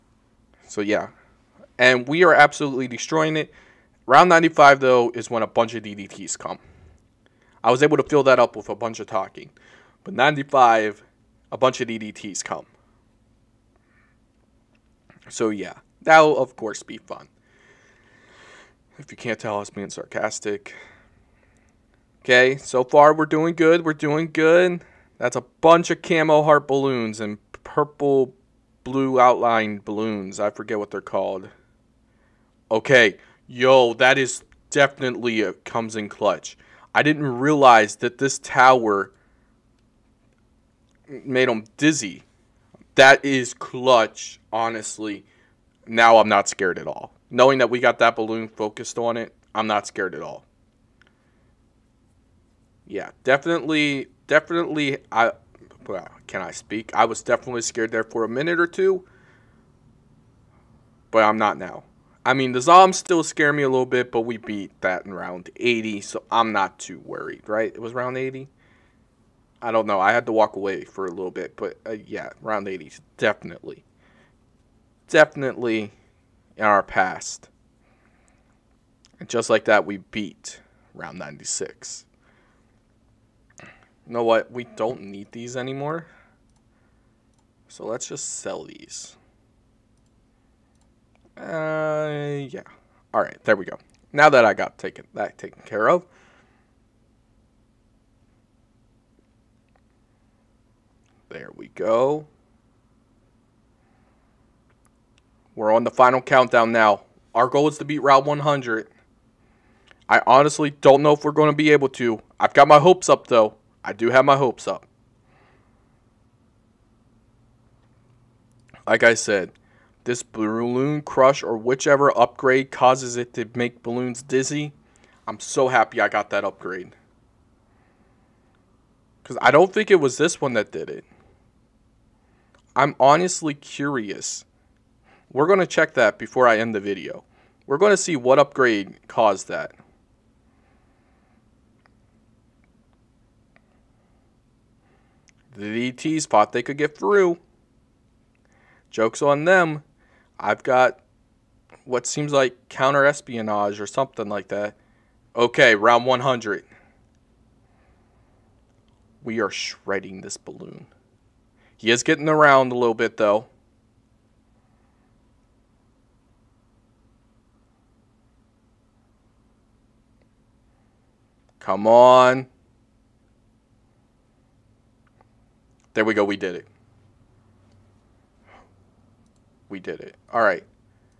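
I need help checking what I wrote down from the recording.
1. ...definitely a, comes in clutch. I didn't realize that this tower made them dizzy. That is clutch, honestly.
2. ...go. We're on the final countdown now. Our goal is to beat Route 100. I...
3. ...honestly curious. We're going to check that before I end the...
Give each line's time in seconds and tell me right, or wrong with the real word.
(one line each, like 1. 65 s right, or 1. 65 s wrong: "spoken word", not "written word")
1. 34 s right
2. 101 s right
3. 132 s right.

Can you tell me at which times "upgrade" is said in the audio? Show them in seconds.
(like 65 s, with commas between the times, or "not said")
122 s, 126 s, 138 s.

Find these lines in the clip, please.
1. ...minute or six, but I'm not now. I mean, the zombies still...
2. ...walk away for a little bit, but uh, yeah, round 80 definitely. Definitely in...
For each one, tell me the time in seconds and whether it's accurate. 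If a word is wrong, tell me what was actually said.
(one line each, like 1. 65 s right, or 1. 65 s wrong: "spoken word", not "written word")
1. 58 s wrong: "two", not "six"
2. 70 s right.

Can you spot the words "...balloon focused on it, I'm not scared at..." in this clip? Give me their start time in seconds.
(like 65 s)
48 s.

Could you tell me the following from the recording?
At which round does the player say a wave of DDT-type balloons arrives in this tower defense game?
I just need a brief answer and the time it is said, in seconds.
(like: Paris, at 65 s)
95, at 4 s.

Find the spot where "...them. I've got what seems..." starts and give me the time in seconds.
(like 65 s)
149 s.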